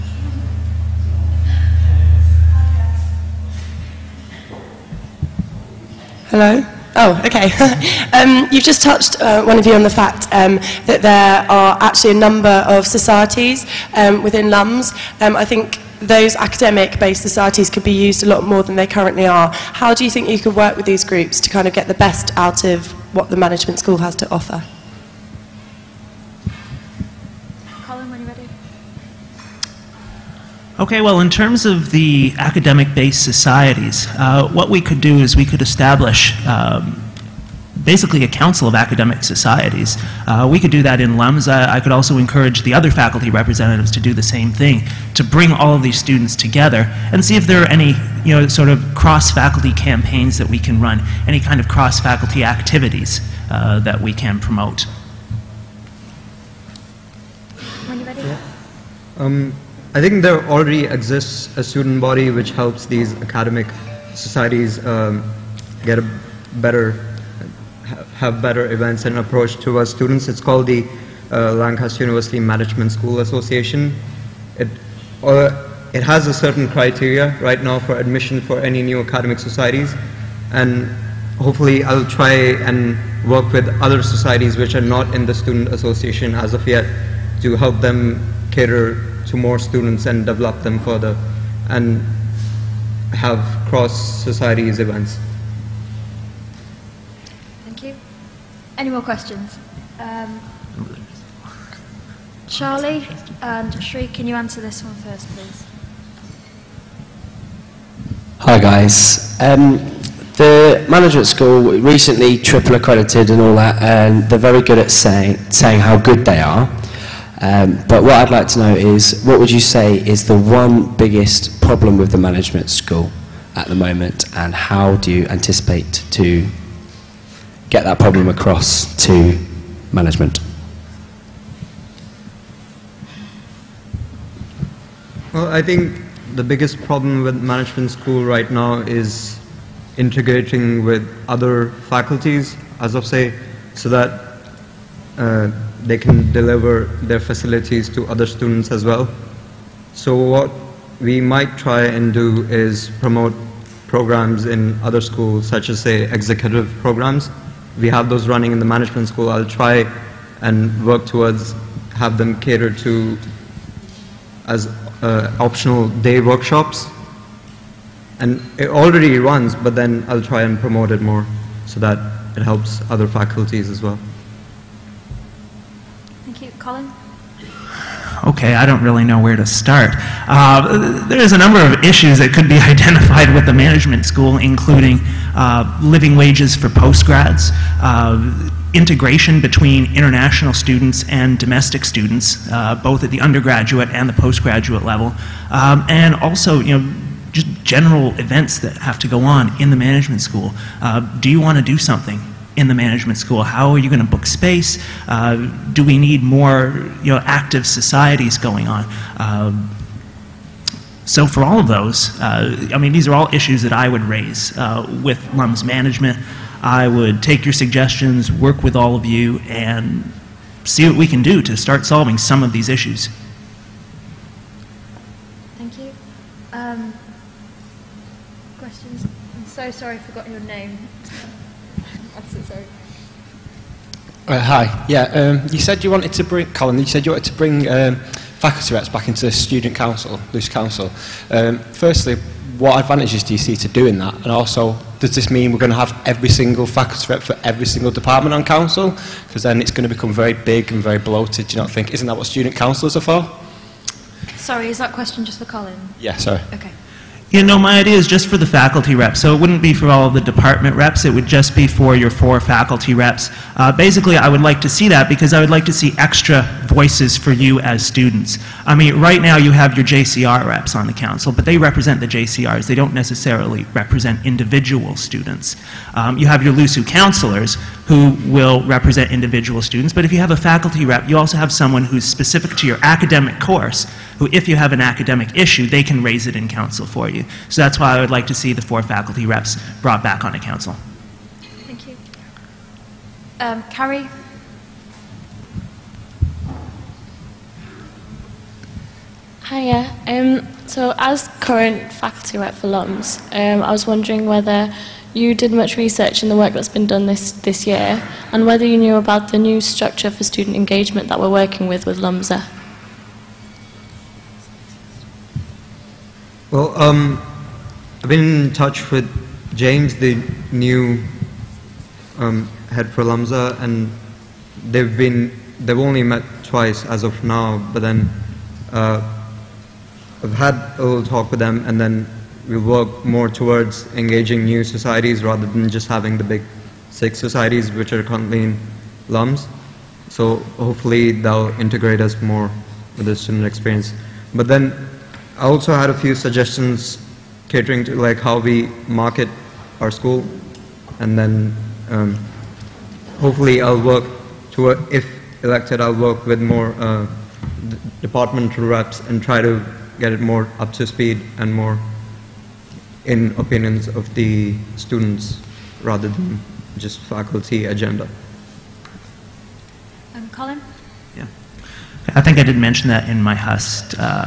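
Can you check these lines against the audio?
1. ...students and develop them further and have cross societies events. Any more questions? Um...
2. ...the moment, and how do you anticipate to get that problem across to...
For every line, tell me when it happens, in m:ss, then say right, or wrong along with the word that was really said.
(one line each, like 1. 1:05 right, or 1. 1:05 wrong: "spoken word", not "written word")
1. 1:29 right
2. 2:03 right.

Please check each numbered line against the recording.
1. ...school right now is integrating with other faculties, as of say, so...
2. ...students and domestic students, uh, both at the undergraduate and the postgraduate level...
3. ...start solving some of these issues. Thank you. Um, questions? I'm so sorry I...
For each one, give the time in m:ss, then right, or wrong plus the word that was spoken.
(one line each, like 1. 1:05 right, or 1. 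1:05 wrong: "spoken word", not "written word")
1. 2:17 right
2. 3:10 right
3. 3:41 right.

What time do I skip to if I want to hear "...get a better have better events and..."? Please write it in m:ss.
1:05.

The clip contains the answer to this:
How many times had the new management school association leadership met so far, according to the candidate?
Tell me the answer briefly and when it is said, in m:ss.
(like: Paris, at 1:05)
2, at 5:26.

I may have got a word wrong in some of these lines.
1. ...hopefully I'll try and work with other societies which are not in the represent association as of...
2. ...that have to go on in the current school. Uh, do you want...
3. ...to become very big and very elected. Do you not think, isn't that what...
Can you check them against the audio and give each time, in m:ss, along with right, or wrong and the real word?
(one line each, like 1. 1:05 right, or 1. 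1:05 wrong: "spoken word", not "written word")
1. 1:21 wrong: "student", not "represent"
2. 3:18 wrong: "management", not "current"
3. 4:09 wrong: "bloated", not "elected".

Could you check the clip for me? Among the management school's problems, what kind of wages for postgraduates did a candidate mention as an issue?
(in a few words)
Living wages.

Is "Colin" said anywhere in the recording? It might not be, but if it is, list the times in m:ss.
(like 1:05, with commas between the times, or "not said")
0:27, 2:56, 3:56, 4:15, 6:10.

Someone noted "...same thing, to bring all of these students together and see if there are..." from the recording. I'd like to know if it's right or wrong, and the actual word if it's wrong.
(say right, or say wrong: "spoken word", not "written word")
right.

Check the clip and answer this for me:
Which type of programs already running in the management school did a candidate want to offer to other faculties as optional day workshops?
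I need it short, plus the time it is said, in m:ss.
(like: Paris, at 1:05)
Executive programs, at 2:36.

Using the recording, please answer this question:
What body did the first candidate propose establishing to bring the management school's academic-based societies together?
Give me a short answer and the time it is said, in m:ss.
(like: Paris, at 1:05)
Council of academic societies, at 0:38.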